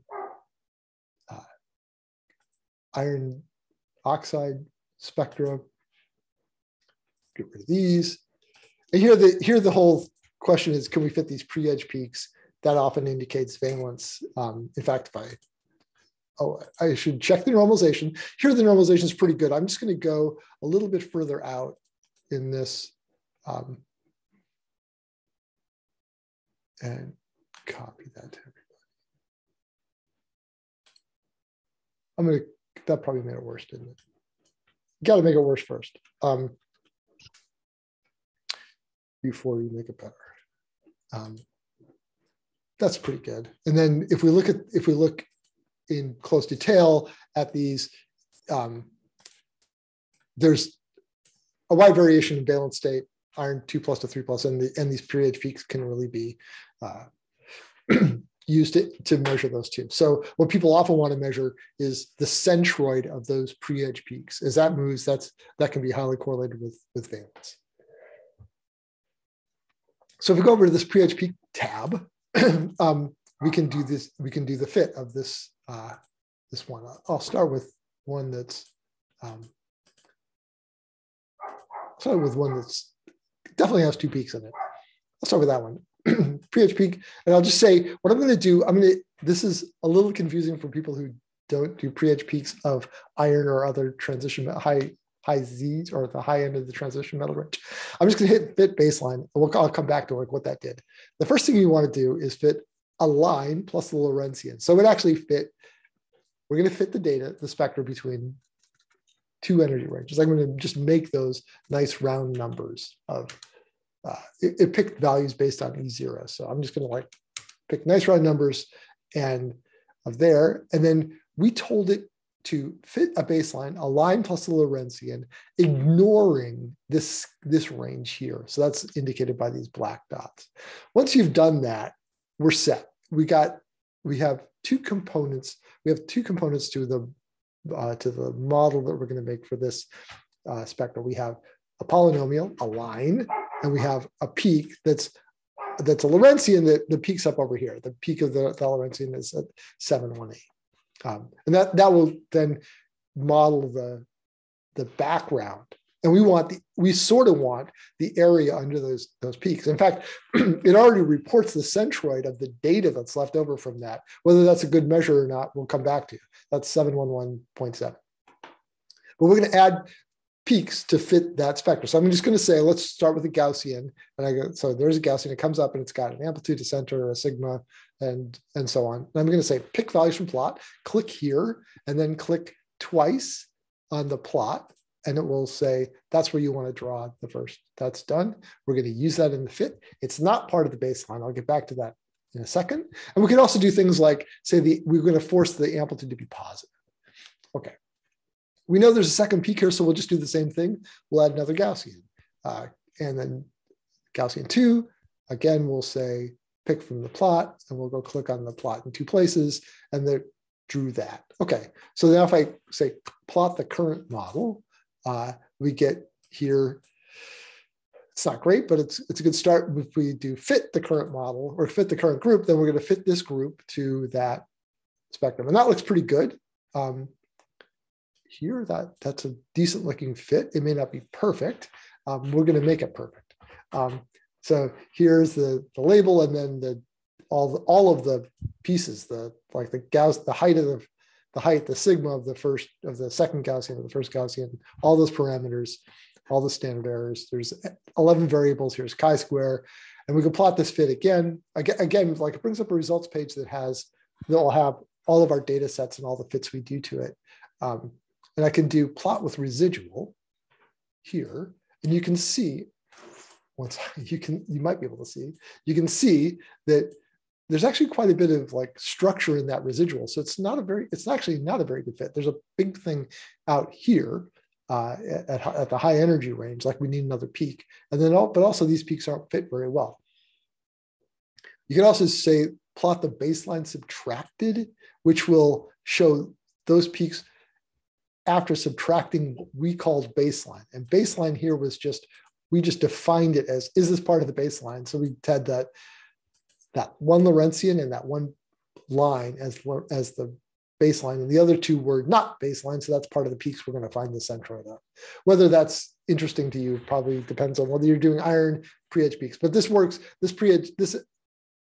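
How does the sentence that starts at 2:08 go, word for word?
So that's indicated by these black dots.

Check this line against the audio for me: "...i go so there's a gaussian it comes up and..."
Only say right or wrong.
right.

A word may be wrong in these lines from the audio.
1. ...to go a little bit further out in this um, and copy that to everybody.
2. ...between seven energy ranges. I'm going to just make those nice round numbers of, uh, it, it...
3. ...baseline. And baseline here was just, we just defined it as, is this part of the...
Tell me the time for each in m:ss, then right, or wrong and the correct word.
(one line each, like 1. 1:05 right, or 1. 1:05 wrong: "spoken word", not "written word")
1. 0:19 right
2. 1:47 wrong: "two", not "seven"
3. 4:50 right.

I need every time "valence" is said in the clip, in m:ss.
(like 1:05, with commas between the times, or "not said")
0:13, 0:52, 1:07.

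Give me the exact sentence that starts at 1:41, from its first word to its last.
The first thing you want to do is fit a line plus the Lorentzian.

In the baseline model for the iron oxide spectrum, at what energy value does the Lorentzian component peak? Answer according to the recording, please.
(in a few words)
718.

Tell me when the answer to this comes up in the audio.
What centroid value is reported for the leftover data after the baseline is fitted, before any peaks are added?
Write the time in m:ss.
2:46.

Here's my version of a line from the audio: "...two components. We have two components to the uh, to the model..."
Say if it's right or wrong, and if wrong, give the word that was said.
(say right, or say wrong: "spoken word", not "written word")
right.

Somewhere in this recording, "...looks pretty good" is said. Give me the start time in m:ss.
3:45.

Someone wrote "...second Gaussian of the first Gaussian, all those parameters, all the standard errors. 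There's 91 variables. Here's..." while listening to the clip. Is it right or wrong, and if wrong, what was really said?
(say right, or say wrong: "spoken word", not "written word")
wrong: "11", not "91".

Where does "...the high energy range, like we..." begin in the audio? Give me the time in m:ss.
4:35.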